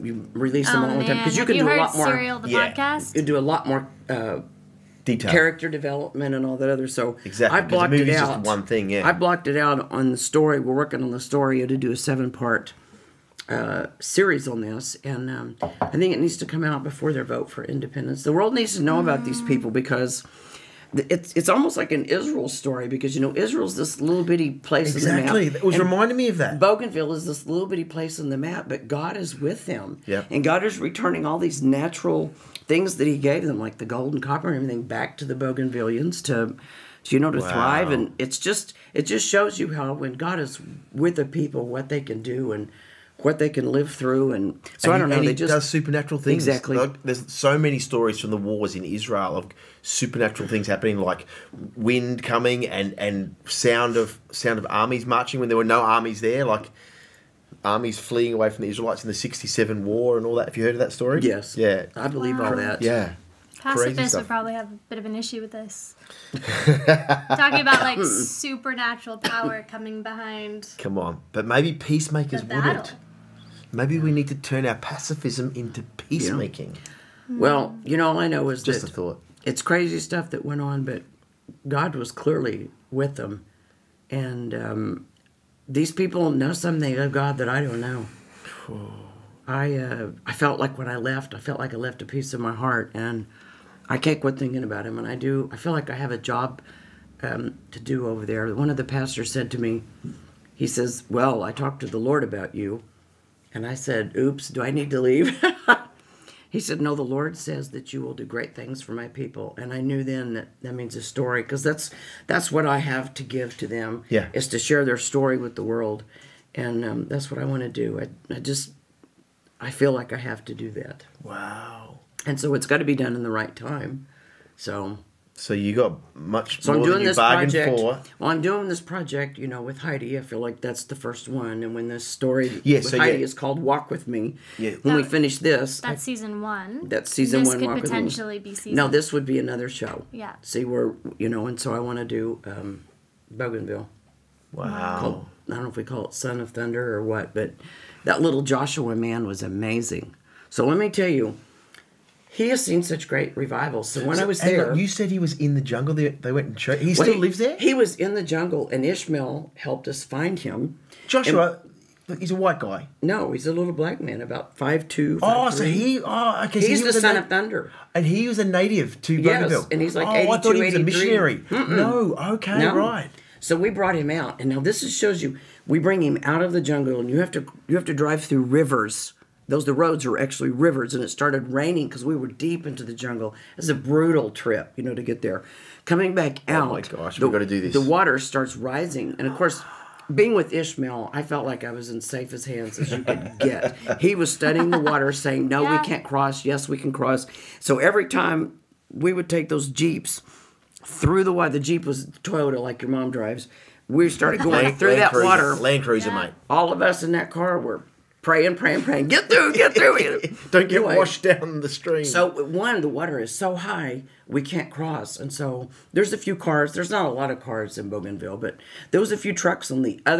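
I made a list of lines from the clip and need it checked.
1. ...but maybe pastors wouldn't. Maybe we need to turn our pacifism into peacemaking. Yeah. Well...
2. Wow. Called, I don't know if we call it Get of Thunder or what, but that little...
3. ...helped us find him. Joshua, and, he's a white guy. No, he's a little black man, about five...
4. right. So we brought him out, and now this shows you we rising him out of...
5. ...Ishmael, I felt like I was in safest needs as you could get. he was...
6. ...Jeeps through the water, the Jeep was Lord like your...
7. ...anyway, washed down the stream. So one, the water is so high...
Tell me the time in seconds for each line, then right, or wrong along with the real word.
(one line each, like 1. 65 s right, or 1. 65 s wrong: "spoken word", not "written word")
1. 71 s wrong: "peacemakers", not "pastors"
2. 144 s wrong: "Son", not "Get"
3. 159 s right
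4. 172 s wrong: "bring", not "rising"
5. 190 s wrong: "hands", not "needs"
6. 199 s wrong: "Toyota", not "Lord"
7. 210 s right.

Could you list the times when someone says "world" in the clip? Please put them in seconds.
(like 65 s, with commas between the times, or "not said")
18 s, 115 s.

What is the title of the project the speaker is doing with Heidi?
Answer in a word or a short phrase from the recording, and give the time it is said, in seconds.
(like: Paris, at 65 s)
Walk with Me, at 133 s.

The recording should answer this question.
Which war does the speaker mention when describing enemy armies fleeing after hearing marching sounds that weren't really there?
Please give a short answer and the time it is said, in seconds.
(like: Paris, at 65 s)
the '67 war, at 59 s.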